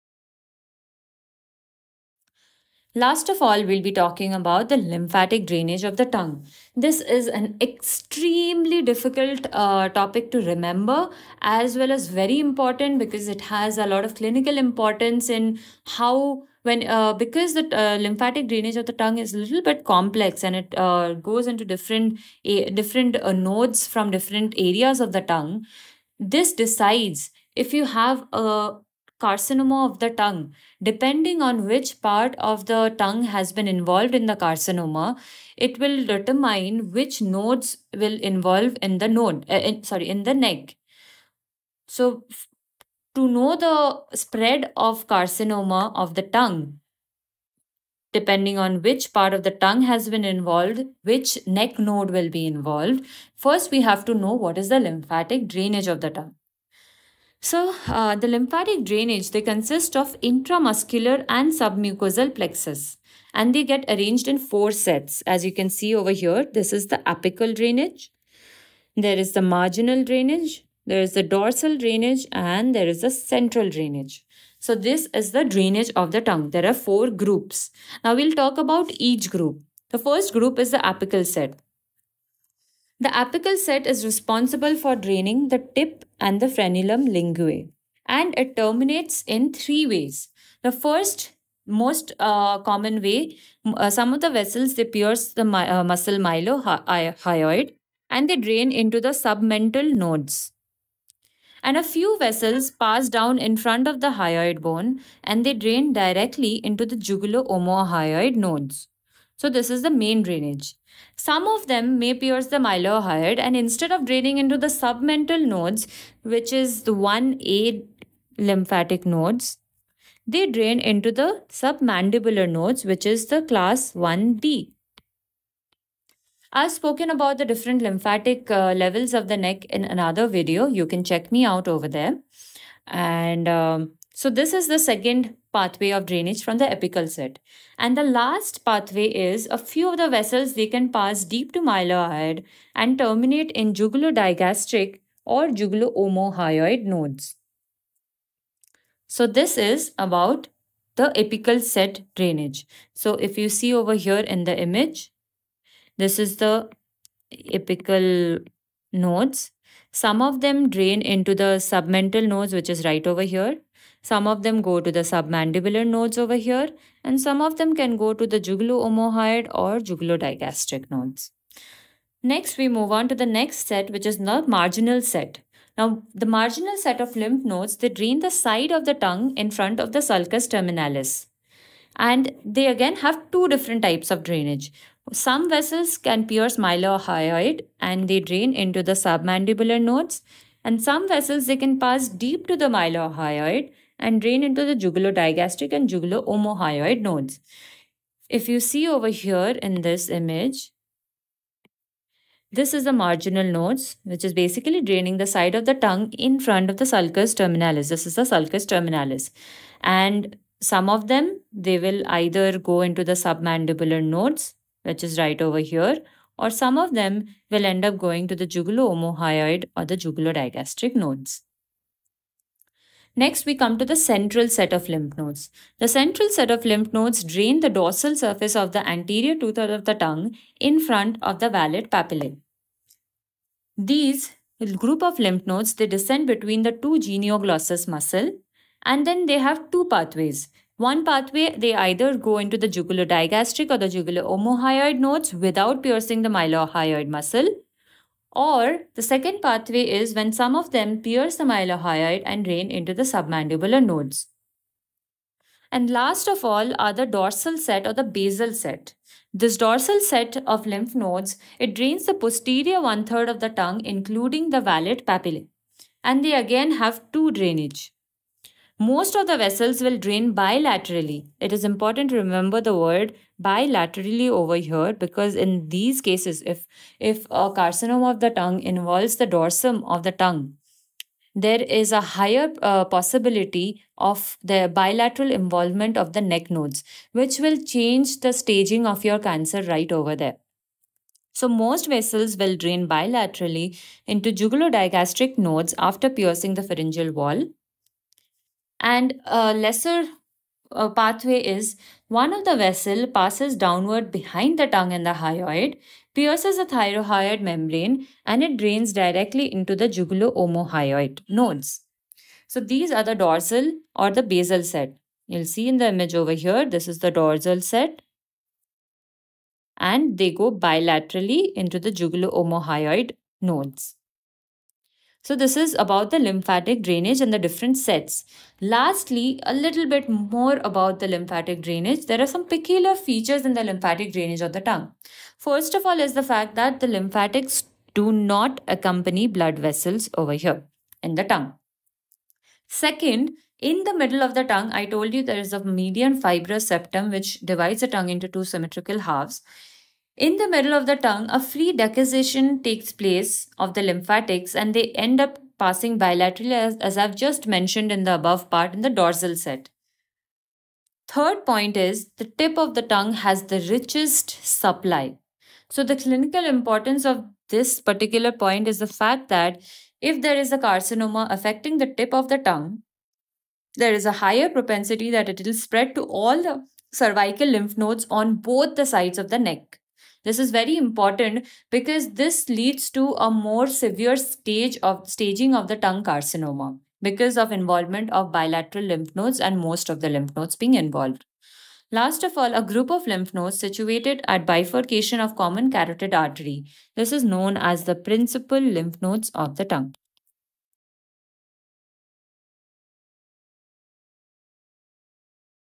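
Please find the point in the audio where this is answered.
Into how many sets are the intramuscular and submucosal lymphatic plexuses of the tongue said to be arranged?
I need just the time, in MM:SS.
01:04.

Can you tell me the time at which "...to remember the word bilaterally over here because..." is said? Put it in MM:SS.
04:32.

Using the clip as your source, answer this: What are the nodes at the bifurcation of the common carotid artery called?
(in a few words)
Principal lymph nodes of the tongue.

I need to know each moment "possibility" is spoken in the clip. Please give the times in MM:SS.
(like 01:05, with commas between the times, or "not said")
04:42.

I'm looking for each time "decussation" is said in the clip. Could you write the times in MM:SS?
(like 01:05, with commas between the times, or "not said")
05:51.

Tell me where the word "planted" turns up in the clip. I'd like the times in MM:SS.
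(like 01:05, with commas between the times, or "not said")
not said.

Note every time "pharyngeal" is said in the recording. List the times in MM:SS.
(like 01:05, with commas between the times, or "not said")
04:56.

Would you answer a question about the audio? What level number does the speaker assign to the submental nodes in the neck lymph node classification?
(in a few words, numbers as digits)
1A.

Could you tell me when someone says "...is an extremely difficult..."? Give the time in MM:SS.
00:06.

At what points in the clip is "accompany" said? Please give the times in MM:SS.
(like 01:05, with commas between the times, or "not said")
05:38.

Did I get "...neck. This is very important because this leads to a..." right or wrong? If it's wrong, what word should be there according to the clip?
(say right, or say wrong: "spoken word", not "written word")
right.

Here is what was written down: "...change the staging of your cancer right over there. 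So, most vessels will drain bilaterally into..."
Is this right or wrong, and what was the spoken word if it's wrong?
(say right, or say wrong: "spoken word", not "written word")
right.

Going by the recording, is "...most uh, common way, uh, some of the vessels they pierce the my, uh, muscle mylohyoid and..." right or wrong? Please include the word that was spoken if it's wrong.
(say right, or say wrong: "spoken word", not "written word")
right.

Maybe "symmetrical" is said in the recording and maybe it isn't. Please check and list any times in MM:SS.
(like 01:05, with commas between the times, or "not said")
05:48.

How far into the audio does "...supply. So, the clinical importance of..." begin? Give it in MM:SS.
06:04.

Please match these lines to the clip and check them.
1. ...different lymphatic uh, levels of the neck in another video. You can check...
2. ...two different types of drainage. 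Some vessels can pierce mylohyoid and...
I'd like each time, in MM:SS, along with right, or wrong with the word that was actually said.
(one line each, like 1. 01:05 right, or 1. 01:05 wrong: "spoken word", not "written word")
1. 02:07 right
2. 03:03 right.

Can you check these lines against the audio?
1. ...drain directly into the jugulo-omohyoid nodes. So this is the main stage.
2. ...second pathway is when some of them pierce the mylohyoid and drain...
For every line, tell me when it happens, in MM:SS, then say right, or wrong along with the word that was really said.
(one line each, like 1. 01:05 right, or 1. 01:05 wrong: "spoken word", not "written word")
1. 01:45 wrong: "drainage", not "stage"
2. 04:09 right.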